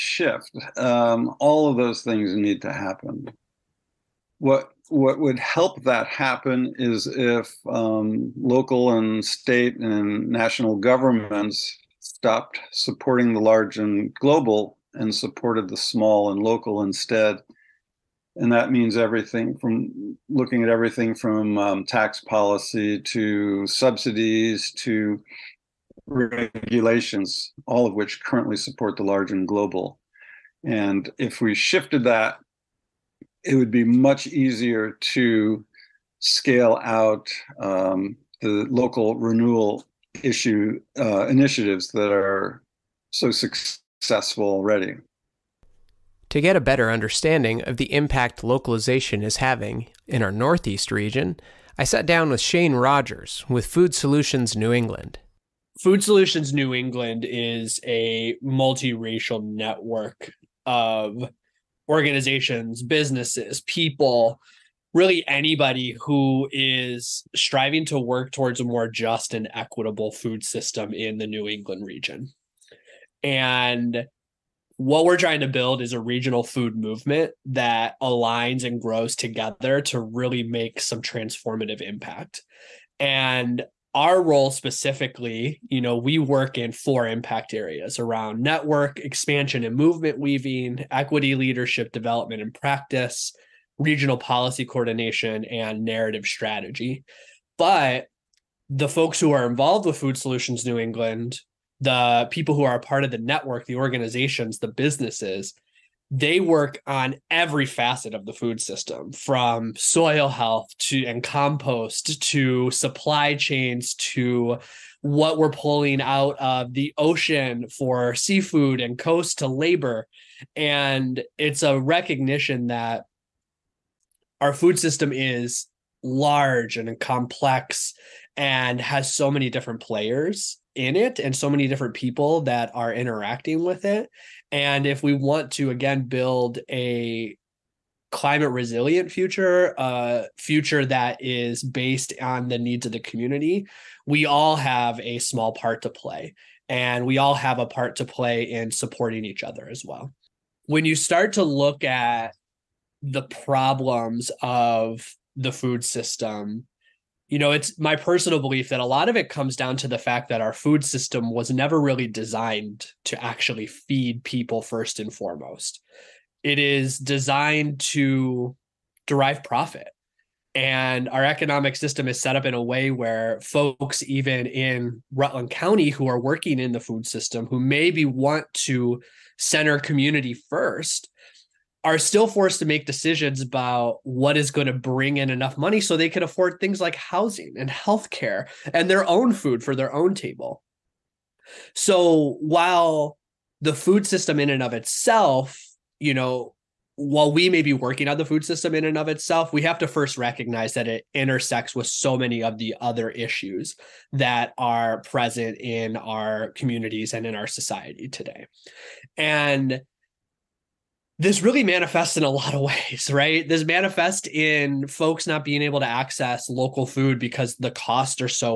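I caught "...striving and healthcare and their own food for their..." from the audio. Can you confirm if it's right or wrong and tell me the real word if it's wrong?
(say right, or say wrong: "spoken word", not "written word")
wrong: "housing", not "striving".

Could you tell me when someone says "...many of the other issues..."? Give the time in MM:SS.
03:22.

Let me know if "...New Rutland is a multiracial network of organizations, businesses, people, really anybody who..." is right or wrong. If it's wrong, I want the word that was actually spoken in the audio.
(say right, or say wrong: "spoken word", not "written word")
wrong: "England", not "Rutland".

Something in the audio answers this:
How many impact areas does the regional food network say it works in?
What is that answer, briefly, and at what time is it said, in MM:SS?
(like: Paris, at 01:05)
4, at 01:26.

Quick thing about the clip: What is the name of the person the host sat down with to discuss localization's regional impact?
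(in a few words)
Shane Rogers.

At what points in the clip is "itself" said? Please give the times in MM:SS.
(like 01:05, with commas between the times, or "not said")
03:14, 03:19.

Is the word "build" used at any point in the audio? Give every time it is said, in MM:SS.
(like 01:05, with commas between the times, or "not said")
01:15, 02:16.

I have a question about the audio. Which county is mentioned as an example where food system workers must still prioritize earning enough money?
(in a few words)
Rutland County.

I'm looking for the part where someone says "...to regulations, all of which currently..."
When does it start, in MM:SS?
00:24.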